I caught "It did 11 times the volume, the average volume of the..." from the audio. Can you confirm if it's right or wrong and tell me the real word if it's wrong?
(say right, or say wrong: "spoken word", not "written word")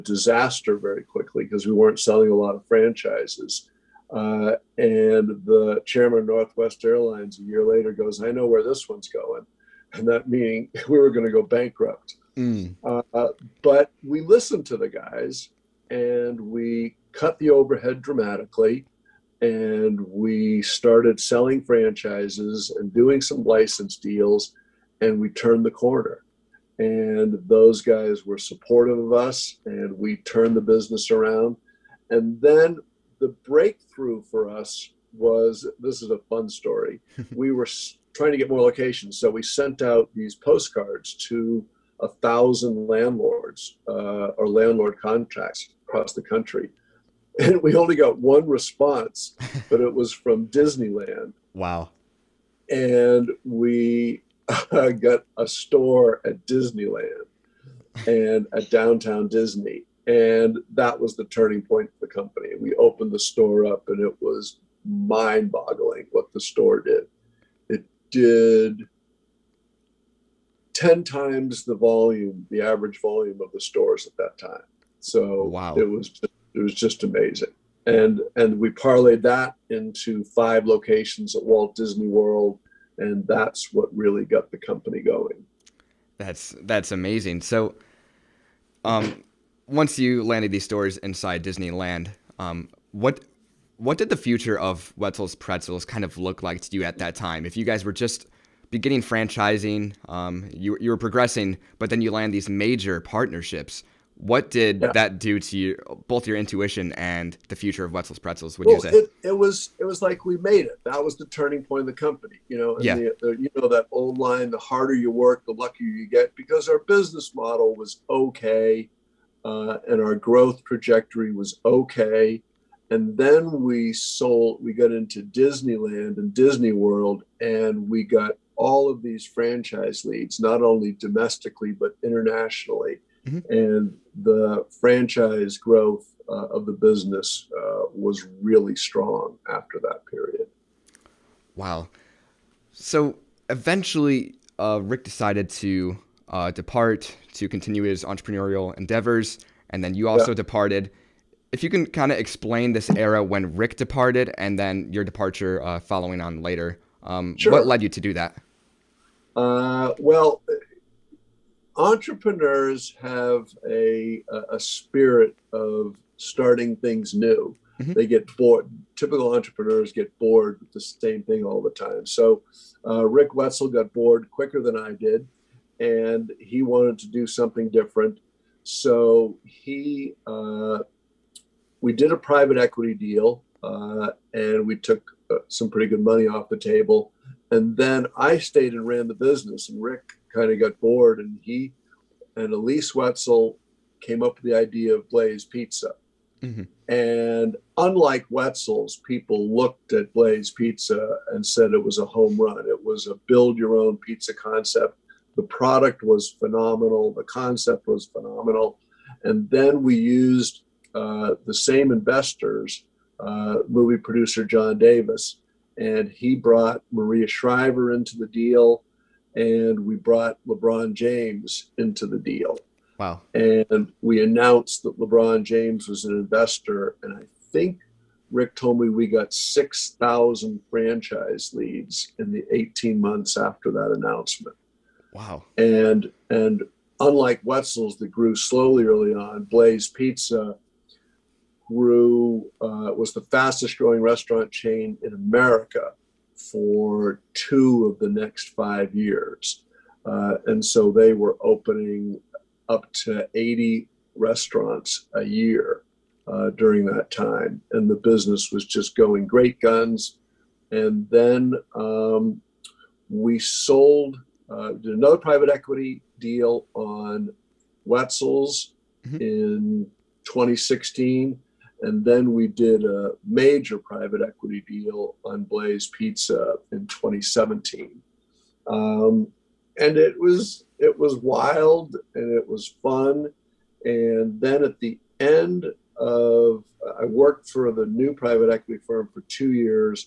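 wrong: "10", not "11".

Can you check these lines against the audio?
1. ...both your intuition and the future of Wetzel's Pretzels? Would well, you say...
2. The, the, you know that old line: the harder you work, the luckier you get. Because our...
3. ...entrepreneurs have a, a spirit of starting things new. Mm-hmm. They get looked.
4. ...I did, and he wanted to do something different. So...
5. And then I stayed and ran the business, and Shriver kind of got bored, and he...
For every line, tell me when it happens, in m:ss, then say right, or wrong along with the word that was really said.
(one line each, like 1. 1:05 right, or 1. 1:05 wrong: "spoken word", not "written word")
1. 1:46 right
2. 1:52 right
3. 2:41 wrong: "bored", not "looked"
4. 2:54 right
5. 3:07 wrong: "Rick", not "Shriver".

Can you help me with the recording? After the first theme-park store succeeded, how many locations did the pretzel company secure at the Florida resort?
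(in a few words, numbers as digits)
5.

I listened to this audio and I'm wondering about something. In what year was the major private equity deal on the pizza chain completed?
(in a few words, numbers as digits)
2017.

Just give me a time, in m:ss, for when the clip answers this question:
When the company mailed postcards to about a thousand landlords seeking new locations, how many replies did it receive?
0:47.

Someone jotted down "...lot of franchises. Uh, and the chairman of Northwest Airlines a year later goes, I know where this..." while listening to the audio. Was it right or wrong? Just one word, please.
right.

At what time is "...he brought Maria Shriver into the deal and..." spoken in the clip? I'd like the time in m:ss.
3:36.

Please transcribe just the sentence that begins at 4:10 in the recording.
Uh, and so they were opening up to 80 restaurants a year uh, during that time.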